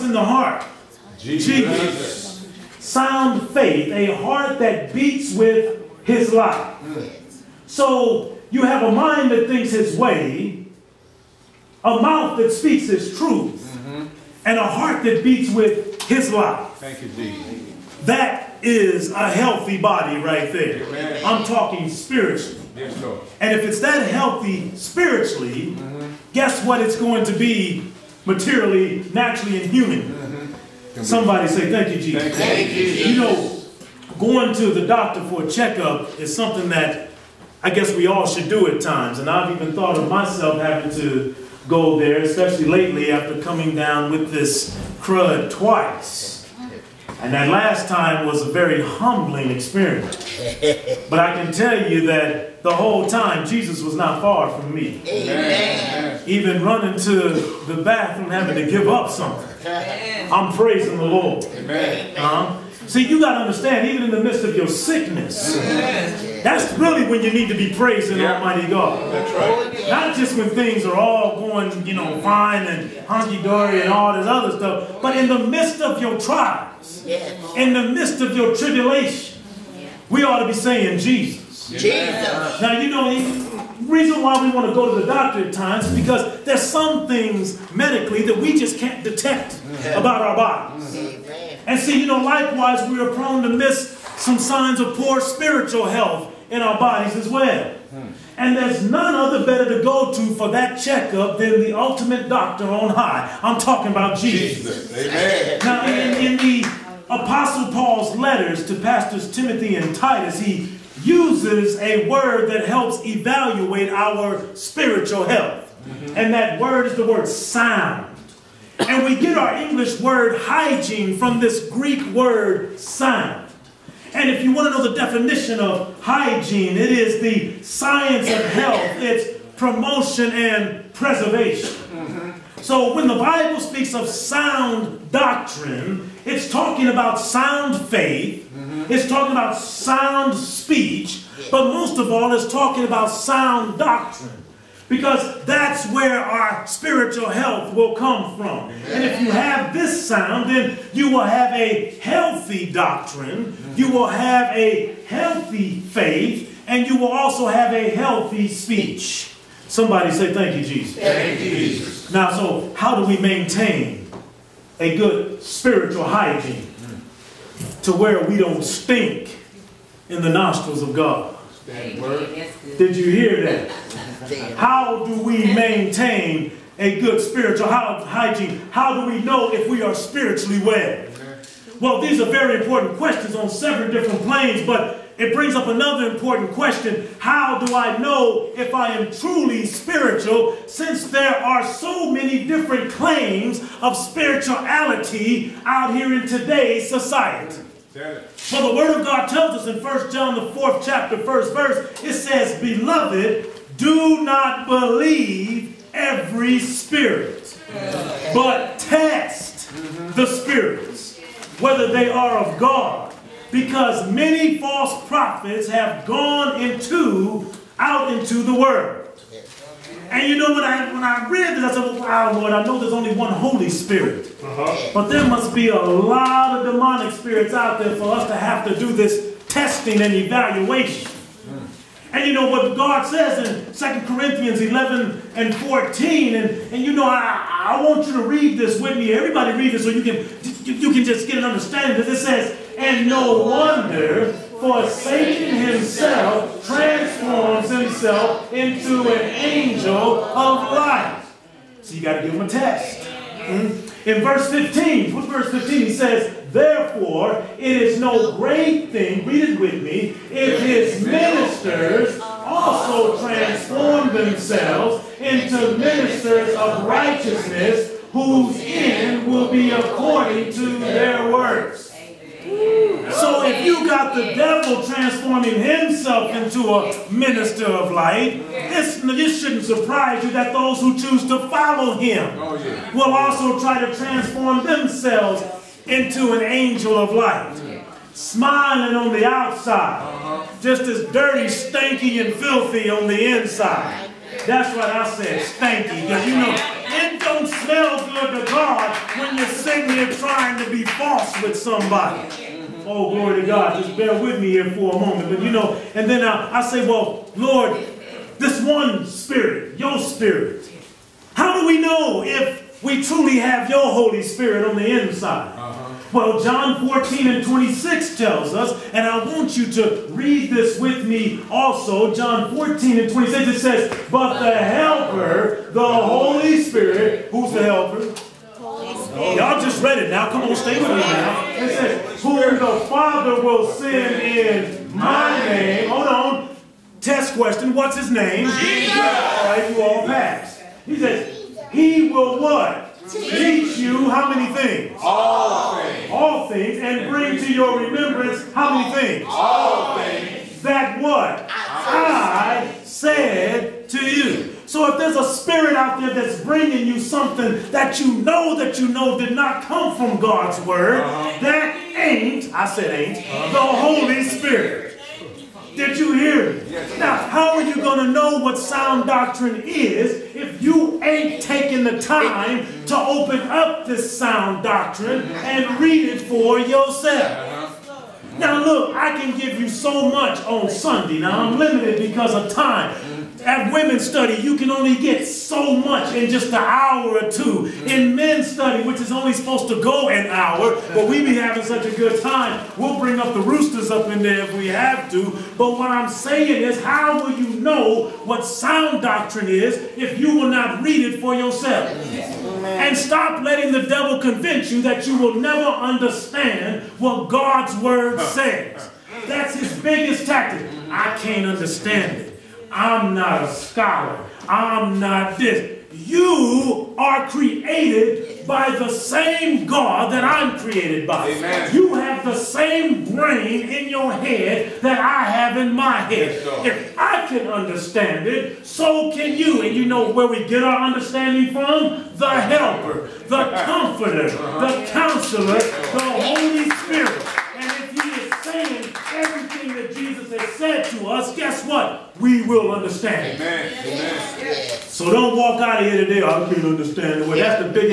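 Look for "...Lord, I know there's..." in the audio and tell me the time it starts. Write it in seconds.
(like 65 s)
222 s.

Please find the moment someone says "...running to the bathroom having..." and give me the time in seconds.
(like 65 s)
56 s.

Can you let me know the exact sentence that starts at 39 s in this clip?
And I've even thought of myself having to go there, especially lately after coming down with this crud twice.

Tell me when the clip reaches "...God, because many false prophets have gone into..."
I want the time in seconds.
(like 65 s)
212 s.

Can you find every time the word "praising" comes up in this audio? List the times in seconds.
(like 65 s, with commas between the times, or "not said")
60 s, 67 s.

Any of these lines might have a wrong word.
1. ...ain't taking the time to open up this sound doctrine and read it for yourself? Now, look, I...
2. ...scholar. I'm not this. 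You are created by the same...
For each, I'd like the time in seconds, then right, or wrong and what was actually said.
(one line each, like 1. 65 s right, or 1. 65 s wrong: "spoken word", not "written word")
1. 371 s right
2. 413 s right.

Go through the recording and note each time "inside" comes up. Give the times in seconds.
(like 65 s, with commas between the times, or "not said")
293 s, 315 s.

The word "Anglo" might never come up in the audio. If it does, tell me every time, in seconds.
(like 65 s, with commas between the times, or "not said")
not said.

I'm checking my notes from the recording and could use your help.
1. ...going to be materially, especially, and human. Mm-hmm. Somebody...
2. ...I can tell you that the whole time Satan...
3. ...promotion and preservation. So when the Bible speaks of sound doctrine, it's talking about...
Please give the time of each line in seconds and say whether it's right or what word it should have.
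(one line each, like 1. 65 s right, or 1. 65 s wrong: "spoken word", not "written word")
1. 26 s wrong: "naturally", not "especially"
2. 51 s wrong: "Jesus", not "Satan"
3. 129 s right.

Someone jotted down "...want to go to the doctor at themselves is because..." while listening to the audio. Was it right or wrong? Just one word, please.
wrong.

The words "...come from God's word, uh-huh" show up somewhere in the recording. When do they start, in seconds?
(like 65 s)
359 s.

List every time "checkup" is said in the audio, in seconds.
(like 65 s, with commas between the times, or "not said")
35 s, 100 s.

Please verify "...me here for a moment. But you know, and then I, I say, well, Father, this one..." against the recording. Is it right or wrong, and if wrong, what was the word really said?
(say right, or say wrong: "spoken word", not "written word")
wrong: "Lord", not "Father".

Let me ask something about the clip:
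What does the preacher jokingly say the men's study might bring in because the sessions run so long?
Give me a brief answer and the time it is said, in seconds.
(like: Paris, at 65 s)
The roosters, at 393 s.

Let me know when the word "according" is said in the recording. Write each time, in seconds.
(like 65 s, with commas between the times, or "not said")
269 s.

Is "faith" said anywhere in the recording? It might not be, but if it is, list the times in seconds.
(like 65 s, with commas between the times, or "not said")
3 s, 137 s, 155 s.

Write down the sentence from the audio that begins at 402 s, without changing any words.
And stop letting the devil convince you that you will never understand what God's word says.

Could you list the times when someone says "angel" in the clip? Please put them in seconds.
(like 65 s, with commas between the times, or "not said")
249 s, 286 s.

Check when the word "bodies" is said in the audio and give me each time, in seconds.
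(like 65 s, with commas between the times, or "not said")
90 s, 96 s.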